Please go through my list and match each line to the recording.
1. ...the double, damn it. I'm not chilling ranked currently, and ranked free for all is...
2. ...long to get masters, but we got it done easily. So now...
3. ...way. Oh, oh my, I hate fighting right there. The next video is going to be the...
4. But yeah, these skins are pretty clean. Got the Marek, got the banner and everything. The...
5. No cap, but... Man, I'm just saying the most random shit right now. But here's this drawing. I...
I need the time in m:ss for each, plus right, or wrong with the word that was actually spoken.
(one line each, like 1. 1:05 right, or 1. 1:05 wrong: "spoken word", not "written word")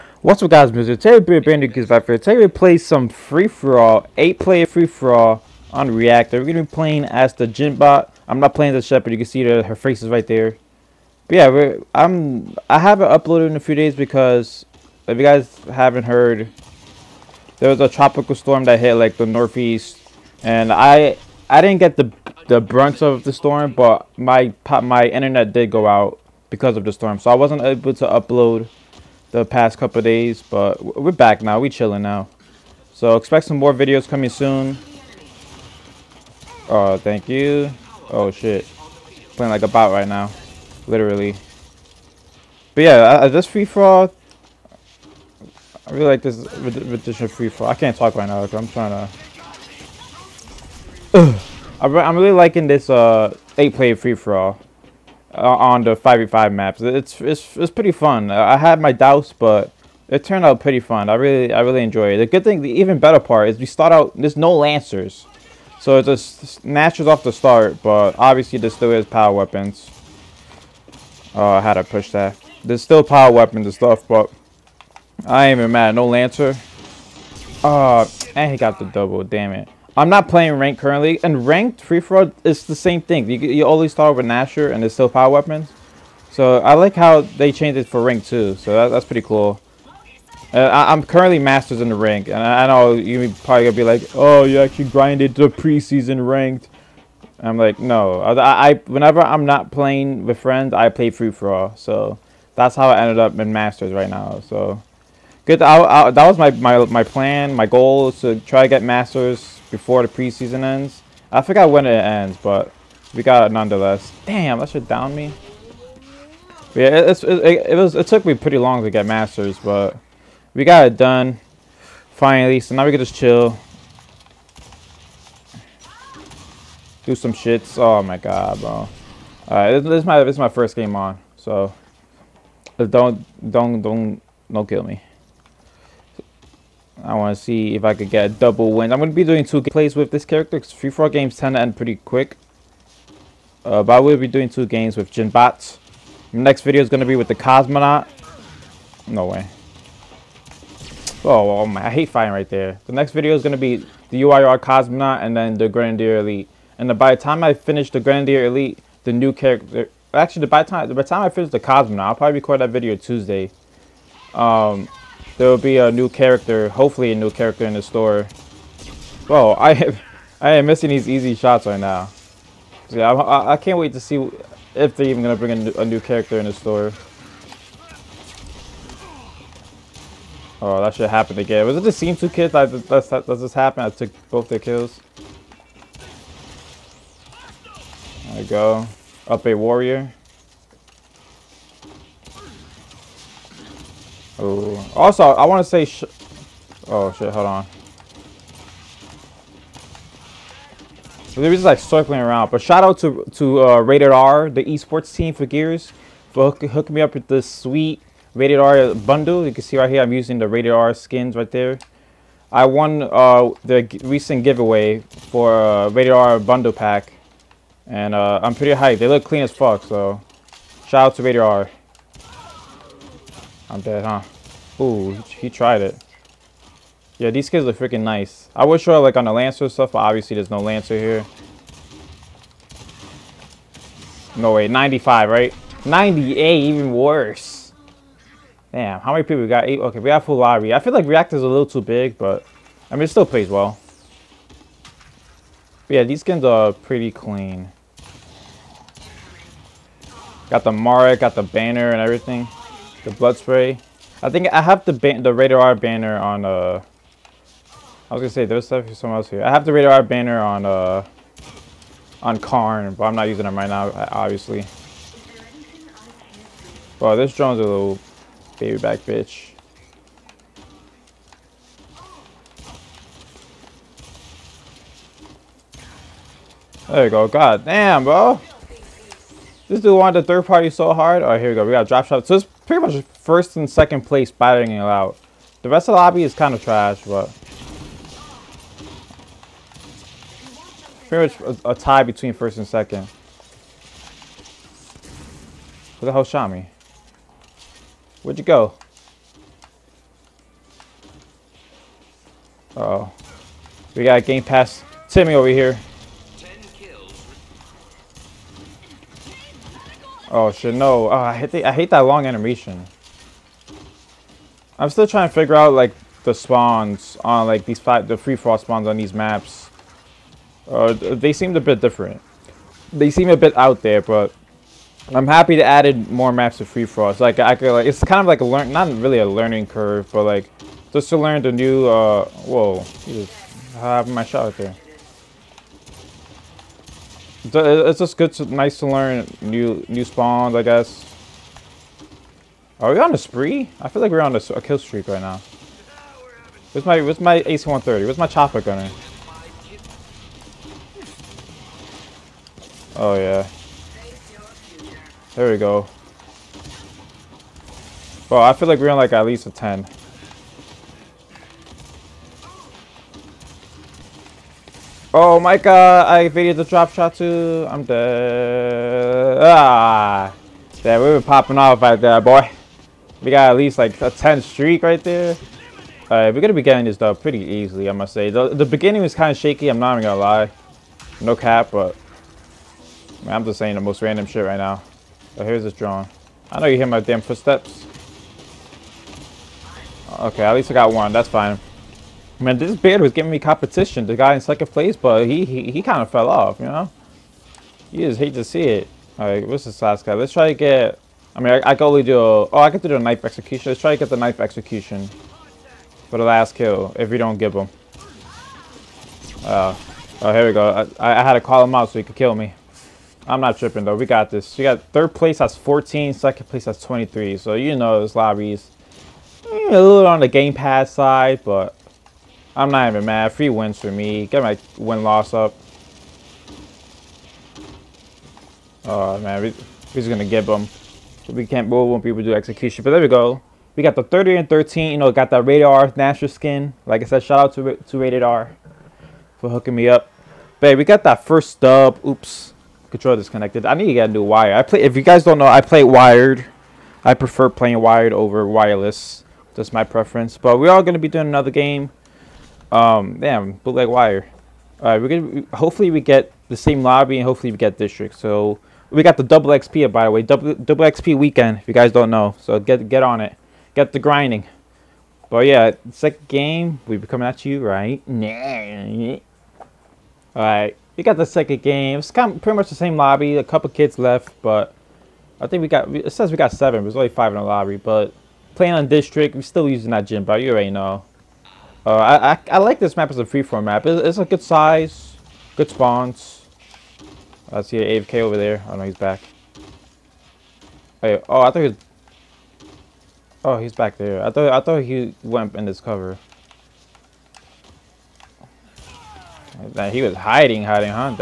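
1. 1:18 wrong: "playing", not "chilling"
2. 1:58 wrong: "finally", not "easily"
3. 2:29 right
4. 4:05 right
5. 6:21 right.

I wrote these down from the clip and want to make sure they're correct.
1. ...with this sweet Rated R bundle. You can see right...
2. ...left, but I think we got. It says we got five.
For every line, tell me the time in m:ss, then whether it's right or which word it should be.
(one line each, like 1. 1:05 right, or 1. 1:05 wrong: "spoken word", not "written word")
1. 3:27 right
2. 7:53 wrong: "seven", not "five".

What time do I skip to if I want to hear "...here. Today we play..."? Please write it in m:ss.
0:02.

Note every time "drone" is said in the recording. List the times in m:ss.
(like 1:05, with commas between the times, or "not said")
4:27.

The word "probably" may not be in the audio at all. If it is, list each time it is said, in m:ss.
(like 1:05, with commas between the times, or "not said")
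1:33, 2:42.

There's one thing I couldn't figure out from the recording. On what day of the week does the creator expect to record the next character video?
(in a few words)
Tuesday.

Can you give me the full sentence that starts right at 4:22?
On Karn, but I'm not using them right now, obviously.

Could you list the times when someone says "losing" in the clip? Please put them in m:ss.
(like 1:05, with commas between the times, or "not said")
not said.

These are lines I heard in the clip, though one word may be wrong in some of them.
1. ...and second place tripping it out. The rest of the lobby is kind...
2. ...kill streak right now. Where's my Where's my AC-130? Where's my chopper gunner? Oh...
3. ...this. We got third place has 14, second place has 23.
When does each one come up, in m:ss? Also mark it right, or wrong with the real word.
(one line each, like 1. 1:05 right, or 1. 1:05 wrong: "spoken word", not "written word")
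1. 4:43 wrong: "battering", not "tripping"
2. 5:44 right
3. 6:54 right.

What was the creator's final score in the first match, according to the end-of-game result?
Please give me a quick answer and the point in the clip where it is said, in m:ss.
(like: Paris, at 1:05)
30, at 7:14.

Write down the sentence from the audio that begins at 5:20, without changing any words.
Uh, they seemed a bit different.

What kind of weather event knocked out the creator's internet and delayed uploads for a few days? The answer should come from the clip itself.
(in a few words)
Tropical storm.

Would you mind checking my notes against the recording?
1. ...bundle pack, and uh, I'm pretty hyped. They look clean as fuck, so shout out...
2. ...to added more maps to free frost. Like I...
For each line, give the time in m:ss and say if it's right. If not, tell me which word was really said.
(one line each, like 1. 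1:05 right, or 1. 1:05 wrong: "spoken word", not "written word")
1. 3:36 right
2. 5:25 right.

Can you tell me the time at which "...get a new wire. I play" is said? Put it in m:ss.
7:23.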